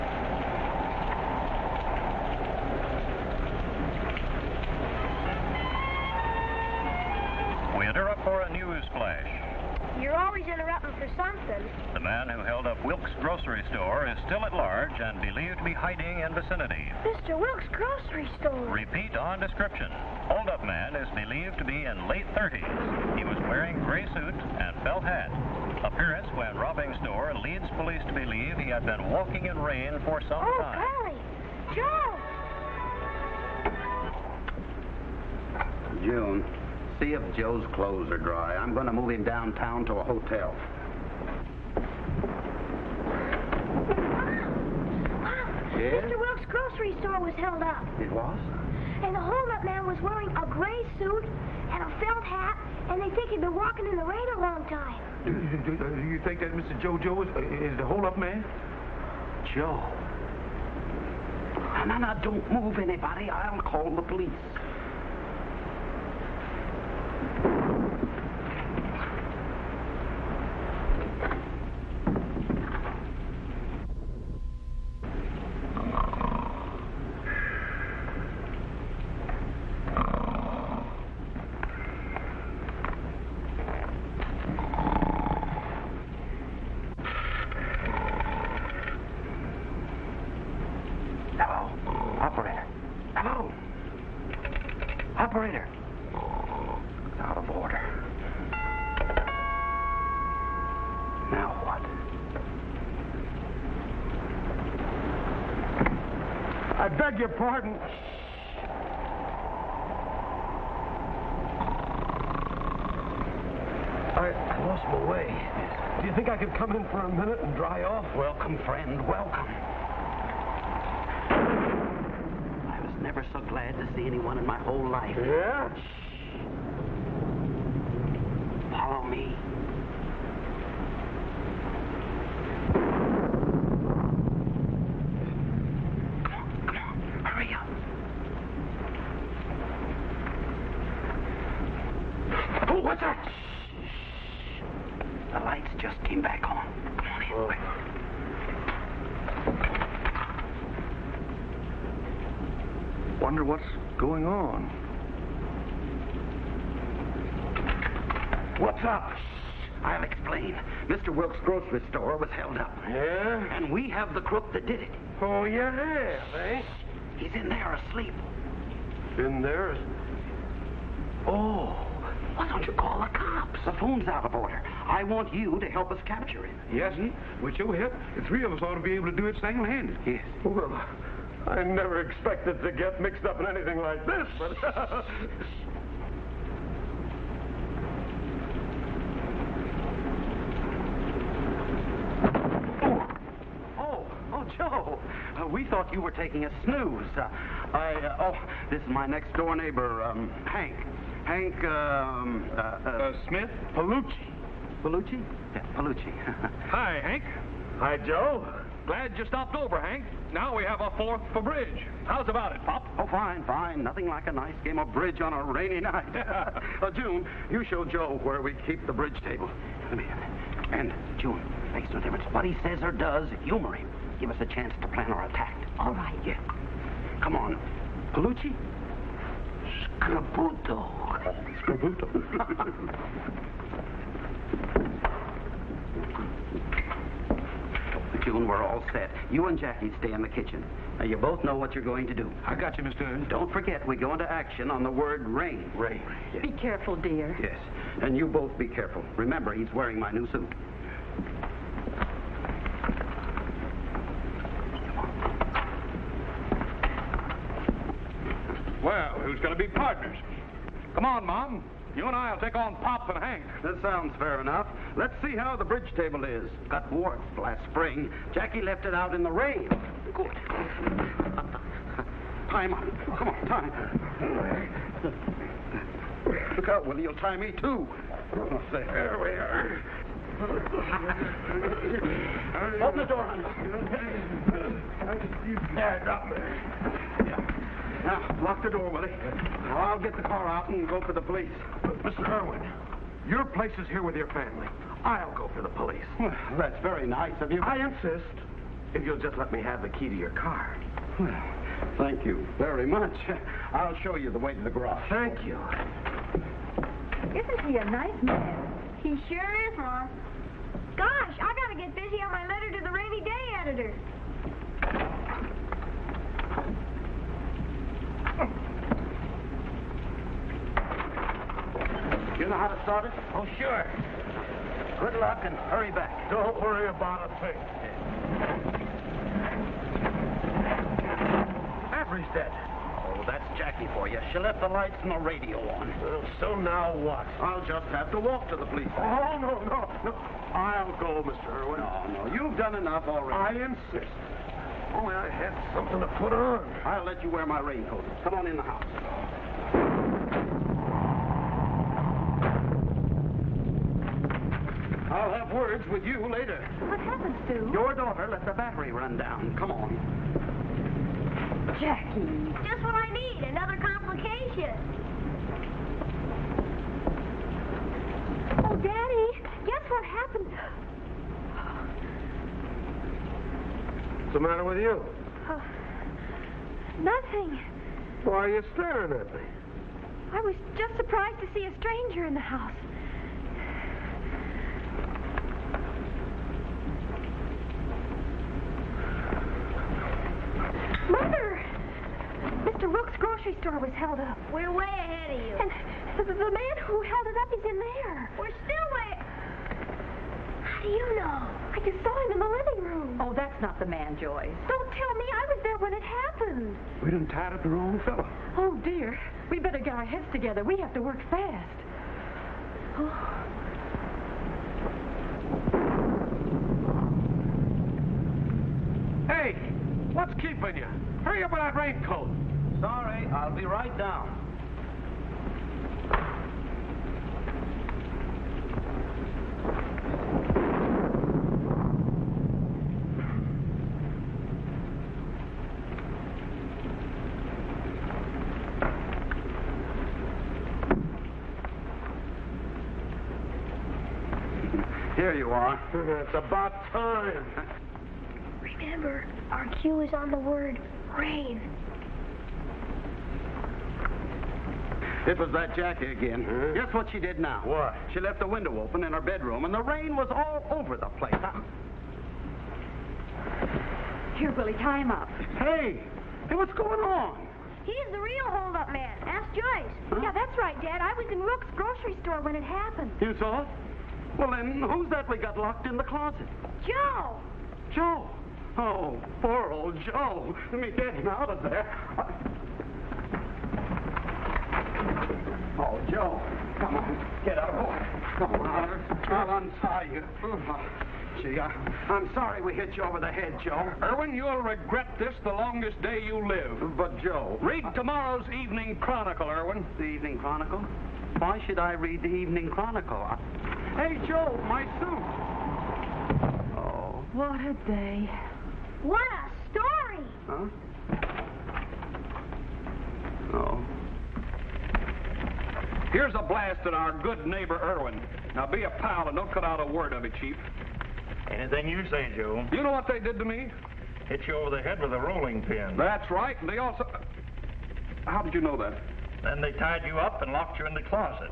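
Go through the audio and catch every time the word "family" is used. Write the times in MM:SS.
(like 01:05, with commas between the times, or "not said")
04:54.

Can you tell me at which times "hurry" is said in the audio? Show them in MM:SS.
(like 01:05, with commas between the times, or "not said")
05:25, 07:01.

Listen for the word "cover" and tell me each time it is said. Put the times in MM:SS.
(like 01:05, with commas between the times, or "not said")
not said.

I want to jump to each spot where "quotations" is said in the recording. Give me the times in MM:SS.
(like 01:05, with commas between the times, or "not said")
not said.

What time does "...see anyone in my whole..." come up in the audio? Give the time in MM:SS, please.
02:03.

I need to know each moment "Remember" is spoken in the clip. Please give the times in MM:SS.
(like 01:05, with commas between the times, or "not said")
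04:09, 07:28.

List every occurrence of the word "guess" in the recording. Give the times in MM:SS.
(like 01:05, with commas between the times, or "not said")
06:09, 07:36.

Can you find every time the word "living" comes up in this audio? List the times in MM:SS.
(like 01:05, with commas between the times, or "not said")
06:42.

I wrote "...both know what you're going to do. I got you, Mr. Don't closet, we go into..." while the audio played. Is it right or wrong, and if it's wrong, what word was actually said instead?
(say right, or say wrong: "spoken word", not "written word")
wrong: "forget", not "closet".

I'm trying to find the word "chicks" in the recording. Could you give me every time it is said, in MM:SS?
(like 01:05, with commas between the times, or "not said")
not said.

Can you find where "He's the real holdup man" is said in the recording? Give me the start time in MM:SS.
07:47.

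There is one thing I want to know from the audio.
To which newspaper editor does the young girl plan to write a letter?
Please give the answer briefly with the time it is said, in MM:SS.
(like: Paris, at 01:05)
rainy day editor, at 05:12.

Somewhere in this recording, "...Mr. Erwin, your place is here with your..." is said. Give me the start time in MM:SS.
04:52.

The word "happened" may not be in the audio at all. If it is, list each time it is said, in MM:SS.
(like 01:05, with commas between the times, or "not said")
05:56, 06:10, 06:46, 07:52.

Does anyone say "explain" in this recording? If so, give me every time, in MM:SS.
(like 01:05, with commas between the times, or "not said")
02:40.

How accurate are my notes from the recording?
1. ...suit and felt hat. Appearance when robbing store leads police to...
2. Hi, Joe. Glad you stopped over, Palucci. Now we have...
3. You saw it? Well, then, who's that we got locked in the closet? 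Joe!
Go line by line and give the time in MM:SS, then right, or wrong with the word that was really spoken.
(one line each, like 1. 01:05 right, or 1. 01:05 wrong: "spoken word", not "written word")
1. 00:24 right
2. 03:27 wrong: "Hank", not "Palucci"
3. 07:53 right.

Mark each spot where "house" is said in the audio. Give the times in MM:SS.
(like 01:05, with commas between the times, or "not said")
05:48, 06:22.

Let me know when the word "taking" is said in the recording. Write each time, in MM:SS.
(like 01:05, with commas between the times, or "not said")
03:16.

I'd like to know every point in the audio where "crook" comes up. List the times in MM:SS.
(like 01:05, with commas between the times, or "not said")
02:44.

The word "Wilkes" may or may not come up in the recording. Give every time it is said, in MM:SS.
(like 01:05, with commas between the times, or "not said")
00:17, 00:46, 02:41.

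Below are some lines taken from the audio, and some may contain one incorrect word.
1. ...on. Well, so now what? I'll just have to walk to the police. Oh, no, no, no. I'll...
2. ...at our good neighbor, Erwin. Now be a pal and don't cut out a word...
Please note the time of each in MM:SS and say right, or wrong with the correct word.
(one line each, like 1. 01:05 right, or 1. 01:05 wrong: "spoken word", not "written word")
1. 05:35 right
2. 08:36 right.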